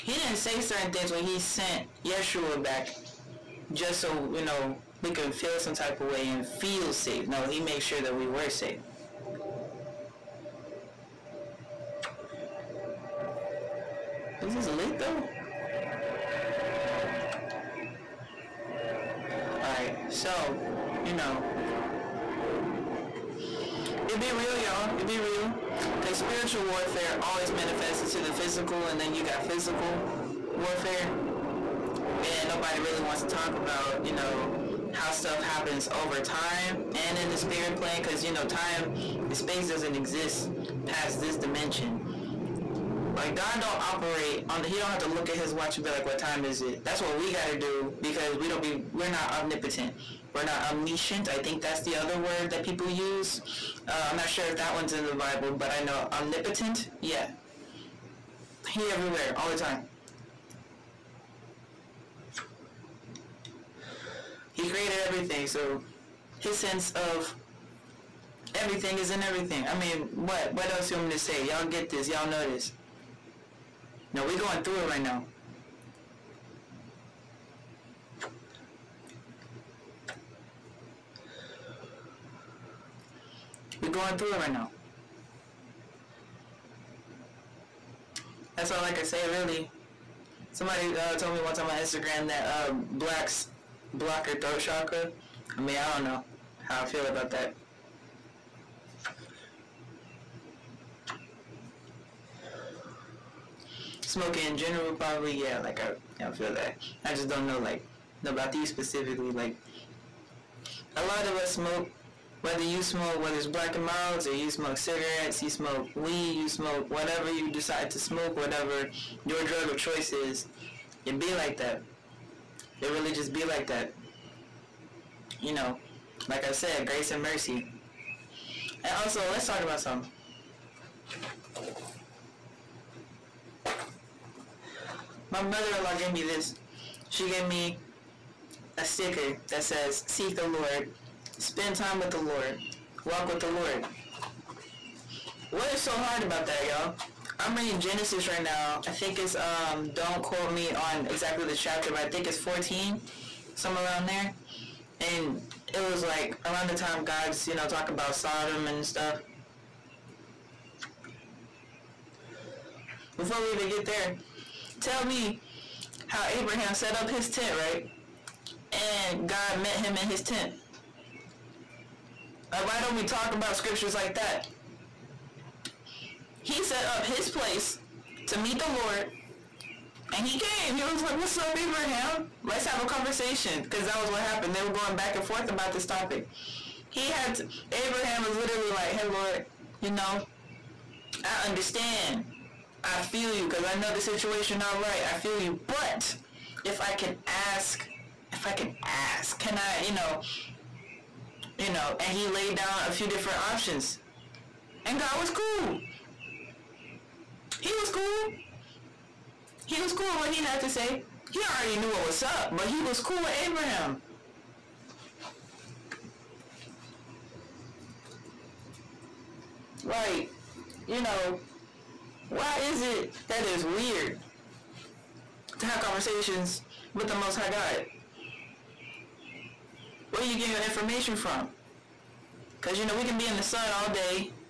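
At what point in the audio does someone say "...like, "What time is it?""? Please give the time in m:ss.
0:45.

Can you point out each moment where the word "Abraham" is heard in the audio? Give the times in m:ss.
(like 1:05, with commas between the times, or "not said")
2:46, 3:01, 3:07, 3:33.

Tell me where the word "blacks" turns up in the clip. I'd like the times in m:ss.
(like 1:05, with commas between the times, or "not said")
1:32, 1:53.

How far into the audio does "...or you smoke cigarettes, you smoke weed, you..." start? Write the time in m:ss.
1:54.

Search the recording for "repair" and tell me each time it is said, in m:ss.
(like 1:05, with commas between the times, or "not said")
not said.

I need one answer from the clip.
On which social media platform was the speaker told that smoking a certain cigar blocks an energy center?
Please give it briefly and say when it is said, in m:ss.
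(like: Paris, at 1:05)
Instagram, at 1:31.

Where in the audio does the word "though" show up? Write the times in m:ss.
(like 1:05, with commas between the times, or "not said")
0:14.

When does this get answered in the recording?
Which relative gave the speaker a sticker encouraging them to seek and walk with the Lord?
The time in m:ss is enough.
2:15.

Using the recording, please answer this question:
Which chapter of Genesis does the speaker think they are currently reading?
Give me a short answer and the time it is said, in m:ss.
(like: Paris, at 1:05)
14, at 2:32.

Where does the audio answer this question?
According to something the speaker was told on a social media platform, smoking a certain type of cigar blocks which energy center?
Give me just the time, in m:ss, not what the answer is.
1:34.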